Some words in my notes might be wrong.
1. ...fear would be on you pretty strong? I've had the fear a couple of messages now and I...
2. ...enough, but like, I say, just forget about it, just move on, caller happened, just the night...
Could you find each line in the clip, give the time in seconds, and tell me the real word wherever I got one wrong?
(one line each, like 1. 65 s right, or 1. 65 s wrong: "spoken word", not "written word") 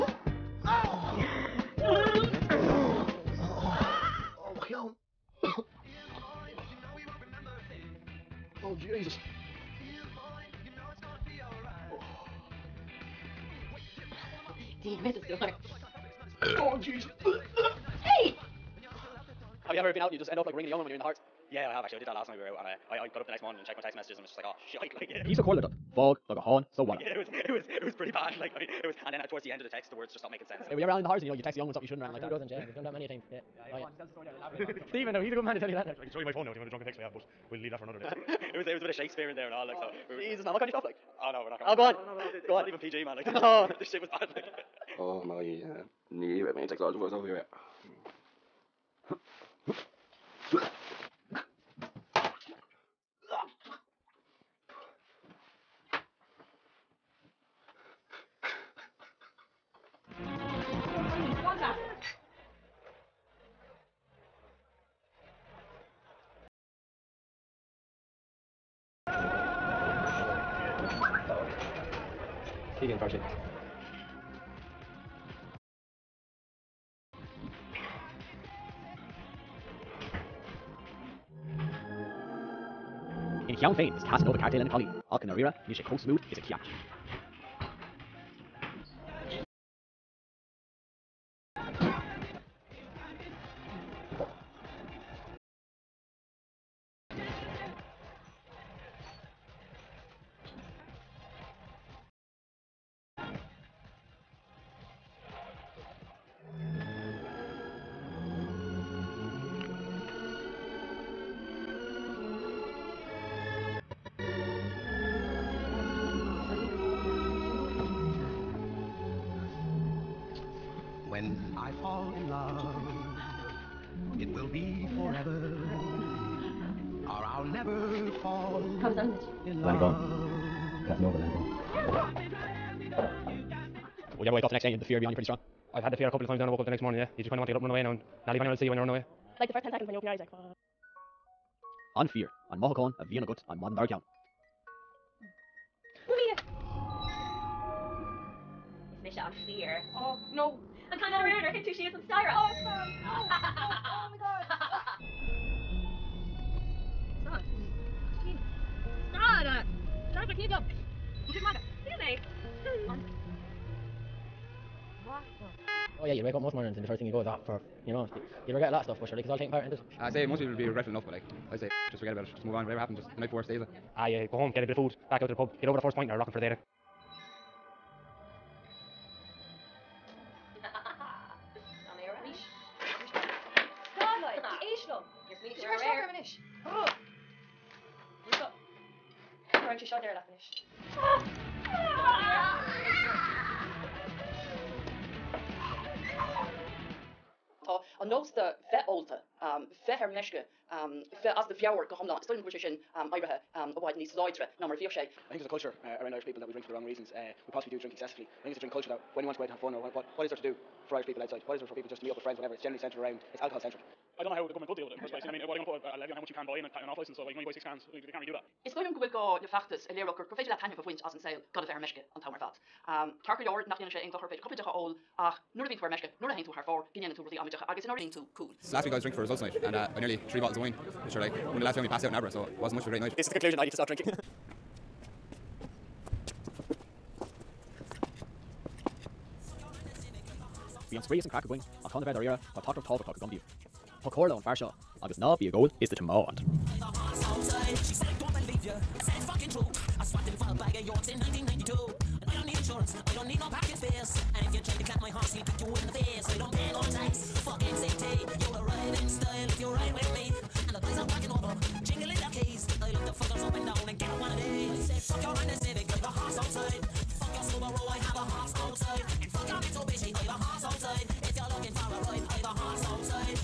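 1. 134 s wrong: "times", not "messages"
2. 170 s wrong: "whatever", not "caller".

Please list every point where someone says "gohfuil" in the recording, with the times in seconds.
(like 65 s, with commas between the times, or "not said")
202 s, 218 s.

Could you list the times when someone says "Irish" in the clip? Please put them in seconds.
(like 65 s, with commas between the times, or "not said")
206 s, 210 s.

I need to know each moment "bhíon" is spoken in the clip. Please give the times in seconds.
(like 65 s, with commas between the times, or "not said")
225 s.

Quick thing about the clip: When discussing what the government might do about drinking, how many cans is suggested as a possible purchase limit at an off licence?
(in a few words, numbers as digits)
6.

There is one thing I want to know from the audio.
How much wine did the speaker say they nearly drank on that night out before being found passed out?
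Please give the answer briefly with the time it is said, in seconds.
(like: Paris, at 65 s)
3 bottles, at 230 s.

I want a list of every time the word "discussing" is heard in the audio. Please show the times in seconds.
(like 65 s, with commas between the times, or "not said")
not said.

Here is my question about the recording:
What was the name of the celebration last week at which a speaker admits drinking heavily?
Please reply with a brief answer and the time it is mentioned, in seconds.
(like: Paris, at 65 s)
Results night, at 229 s.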